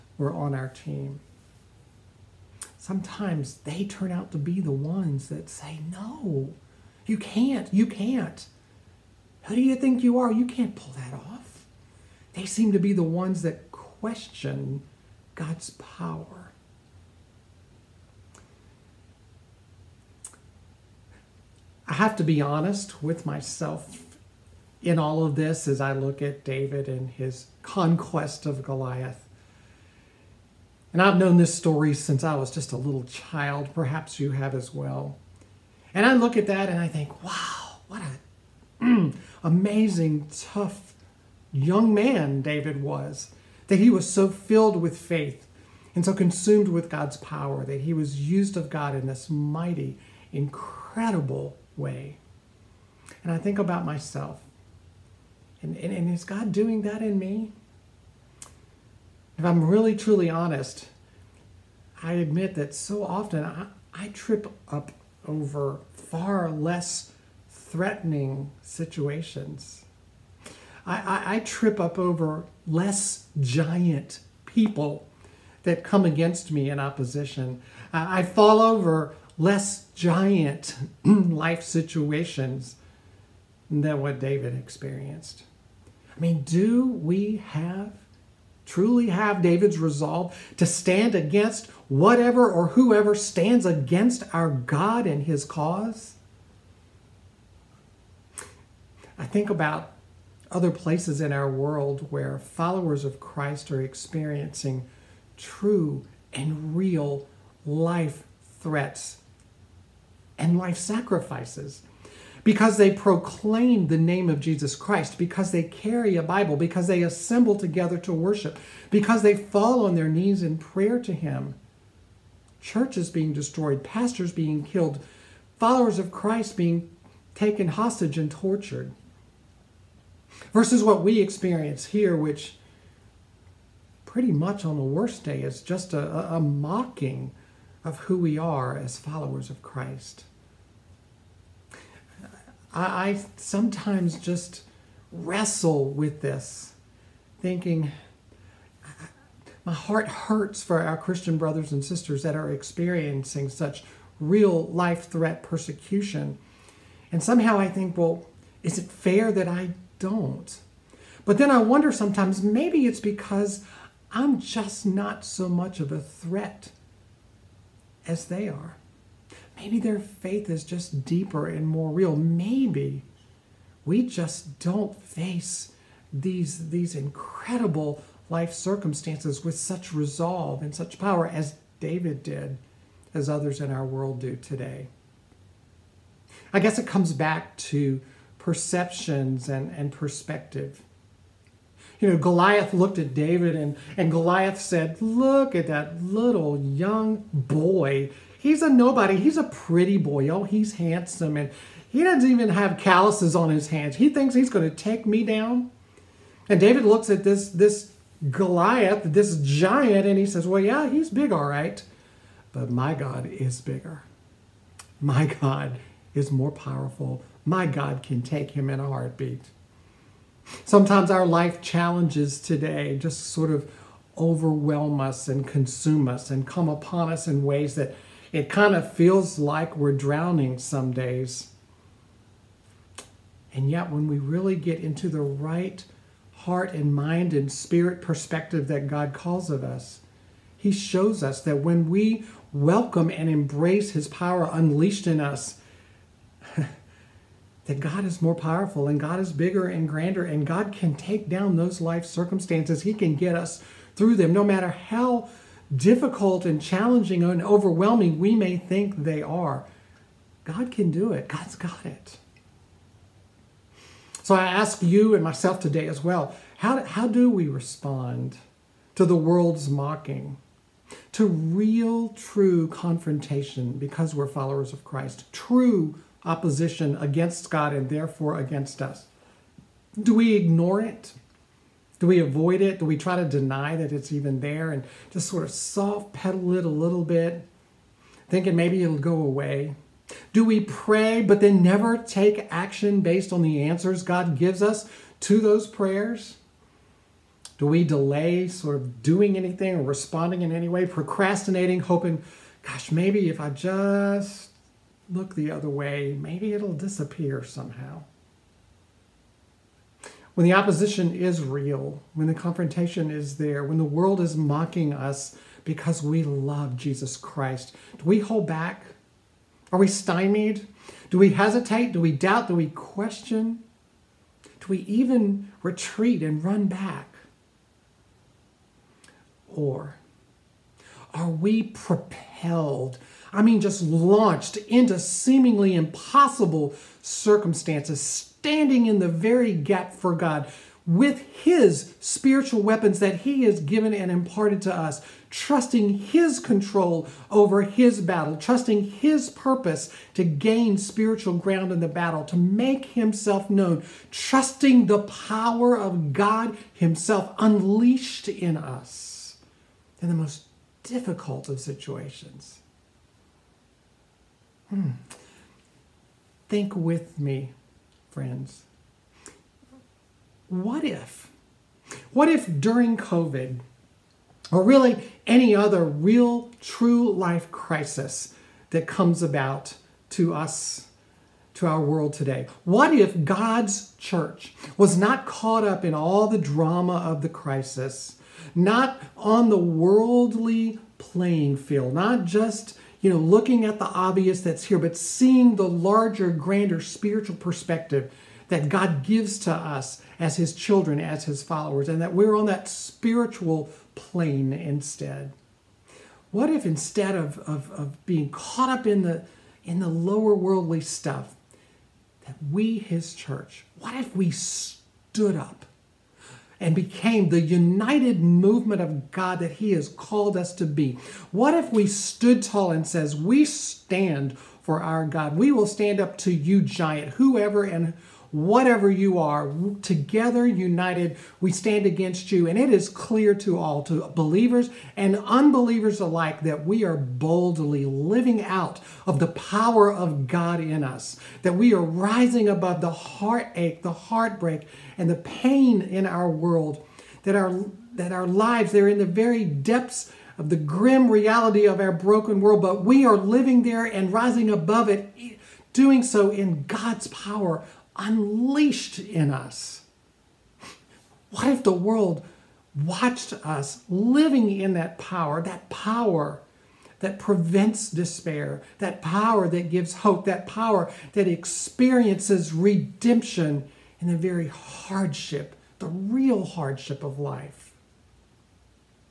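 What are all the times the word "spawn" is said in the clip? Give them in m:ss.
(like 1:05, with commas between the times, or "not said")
not said.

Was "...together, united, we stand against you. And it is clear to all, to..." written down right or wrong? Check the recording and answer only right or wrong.
right.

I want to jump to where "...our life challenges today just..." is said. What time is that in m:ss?
3:41.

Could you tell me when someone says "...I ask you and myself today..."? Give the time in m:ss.
4:24.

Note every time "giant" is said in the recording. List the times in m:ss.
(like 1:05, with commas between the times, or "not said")
1:13, 1:19, 3:29, 7:06.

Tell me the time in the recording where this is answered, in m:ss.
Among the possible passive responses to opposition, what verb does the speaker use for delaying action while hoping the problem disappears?
5:00.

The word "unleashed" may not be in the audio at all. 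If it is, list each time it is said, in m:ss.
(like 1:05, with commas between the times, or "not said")
4:04, 5:57, 7:37.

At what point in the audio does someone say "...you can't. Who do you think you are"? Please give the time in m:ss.
0:07.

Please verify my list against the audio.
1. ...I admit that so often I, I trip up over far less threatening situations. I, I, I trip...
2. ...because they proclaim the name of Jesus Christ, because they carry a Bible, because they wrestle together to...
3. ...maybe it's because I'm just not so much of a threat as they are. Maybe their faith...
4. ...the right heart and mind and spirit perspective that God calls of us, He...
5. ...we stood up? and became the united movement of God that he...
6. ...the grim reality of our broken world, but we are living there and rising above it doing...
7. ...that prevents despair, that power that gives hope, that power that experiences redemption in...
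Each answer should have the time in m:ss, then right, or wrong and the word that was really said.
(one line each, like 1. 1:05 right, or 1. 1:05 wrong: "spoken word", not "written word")
1. 1:02 right
2. 1:52 wrong: "assemble", not "wrestle"
3. 2:42 right
4. 3:55 right
5. 6:54 right
6. 7:30 right
7. 7:46 right.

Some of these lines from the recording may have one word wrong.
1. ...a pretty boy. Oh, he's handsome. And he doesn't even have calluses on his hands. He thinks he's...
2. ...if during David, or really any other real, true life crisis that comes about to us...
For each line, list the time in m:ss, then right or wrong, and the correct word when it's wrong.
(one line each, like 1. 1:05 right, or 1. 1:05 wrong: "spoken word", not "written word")
1. 3:19 right
2. 6:12 wrong: "COVID", not "David".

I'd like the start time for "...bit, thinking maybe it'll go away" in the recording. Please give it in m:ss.
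4:47.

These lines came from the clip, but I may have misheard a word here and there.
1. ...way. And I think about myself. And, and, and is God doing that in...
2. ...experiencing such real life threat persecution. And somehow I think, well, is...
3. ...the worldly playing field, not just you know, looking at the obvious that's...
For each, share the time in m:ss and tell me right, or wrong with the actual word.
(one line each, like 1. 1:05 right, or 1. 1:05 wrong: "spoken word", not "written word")
1. 0:51 right
2. 2:32 right
3. 6:29 right.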